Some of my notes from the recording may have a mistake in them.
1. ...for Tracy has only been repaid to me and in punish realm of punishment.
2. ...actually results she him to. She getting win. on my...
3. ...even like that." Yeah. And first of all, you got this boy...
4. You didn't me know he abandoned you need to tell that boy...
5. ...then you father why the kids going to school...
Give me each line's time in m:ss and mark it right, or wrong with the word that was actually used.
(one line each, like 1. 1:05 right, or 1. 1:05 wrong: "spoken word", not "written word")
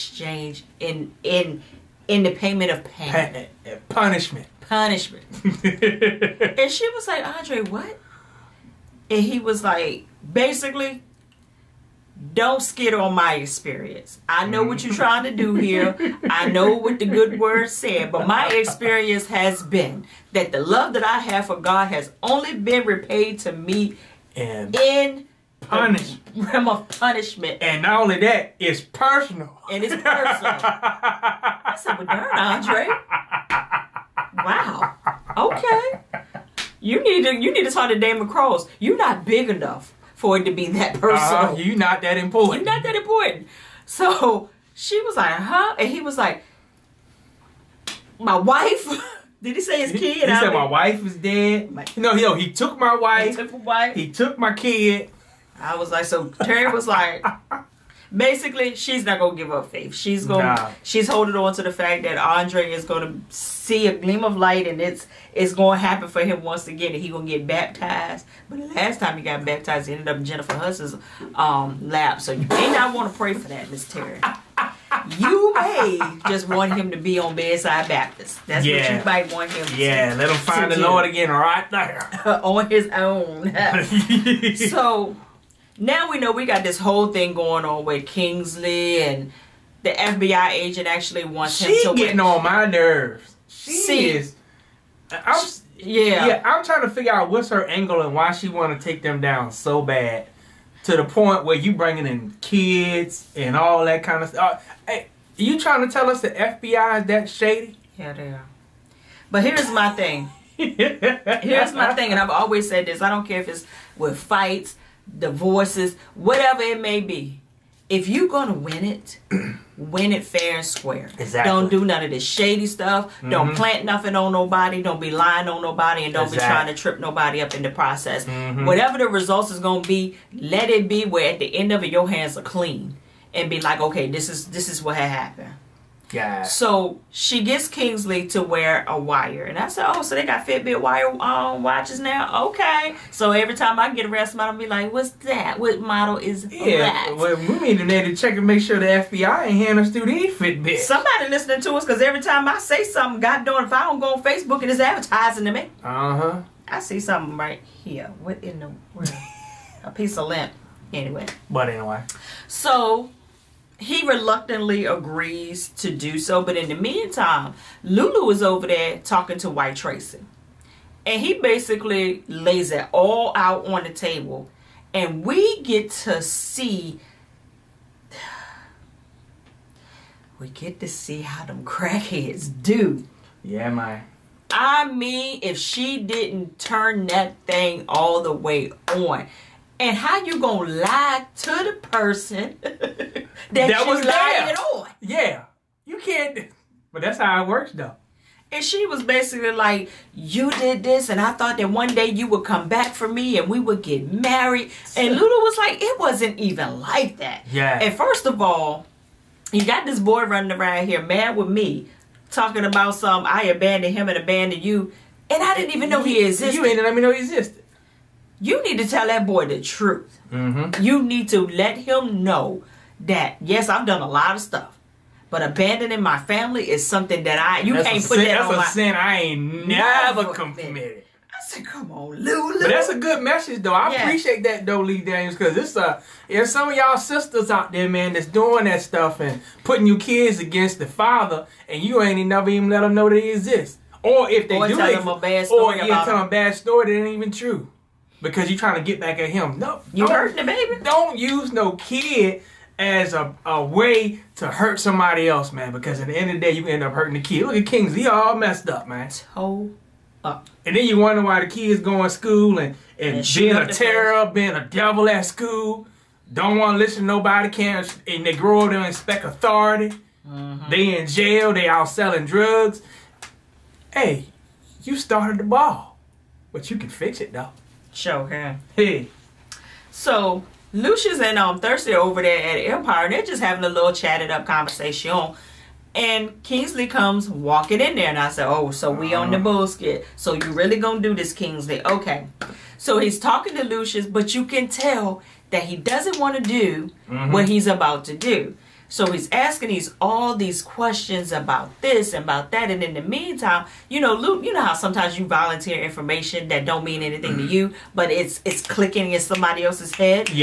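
1. 0:21 wrong: "God", not "Tracy"
2. 1:30 wrong: "wants", not "results"
3. 3:26 right
4. 3:36 wrong: "existed", not "abandoned"
5. 4:20 wrong: "wonder", not "father".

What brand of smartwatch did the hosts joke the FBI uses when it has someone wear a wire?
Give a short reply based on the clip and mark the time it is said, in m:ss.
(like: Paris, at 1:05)
Fitbit, at 2:20.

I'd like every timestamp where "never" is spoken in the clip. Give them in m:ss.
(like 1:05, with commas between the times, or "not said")
3:49, 4:02.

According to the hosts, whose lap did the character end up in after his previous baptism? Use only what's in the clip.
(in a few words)
Jennifer Hudson.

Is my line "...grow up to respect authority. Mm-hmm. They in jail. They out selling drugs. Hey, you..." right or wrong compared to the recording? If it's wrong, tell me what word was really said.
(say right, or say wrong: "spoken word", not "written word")
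right.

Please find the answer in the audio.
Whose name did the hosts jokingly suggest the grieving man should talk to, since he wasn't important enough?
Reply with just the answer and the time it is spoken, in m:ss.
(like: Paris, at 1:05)
Damon Cross, at 0:37.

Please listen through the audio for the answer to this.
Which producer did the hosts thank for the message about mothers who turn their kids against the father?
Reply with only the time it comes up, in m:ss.
3:54.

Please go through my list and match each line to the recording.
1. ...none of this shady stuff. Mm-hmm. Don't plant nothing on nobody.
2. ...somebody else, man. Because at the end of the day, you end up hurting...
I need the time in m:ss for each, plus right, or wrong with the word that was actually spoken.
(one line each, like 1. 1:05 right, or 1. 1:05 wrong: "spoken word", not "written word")
1. 2:01 right
2. 4:14 right.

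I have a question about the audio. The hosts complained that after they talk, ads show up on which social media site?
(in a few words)
Facebook.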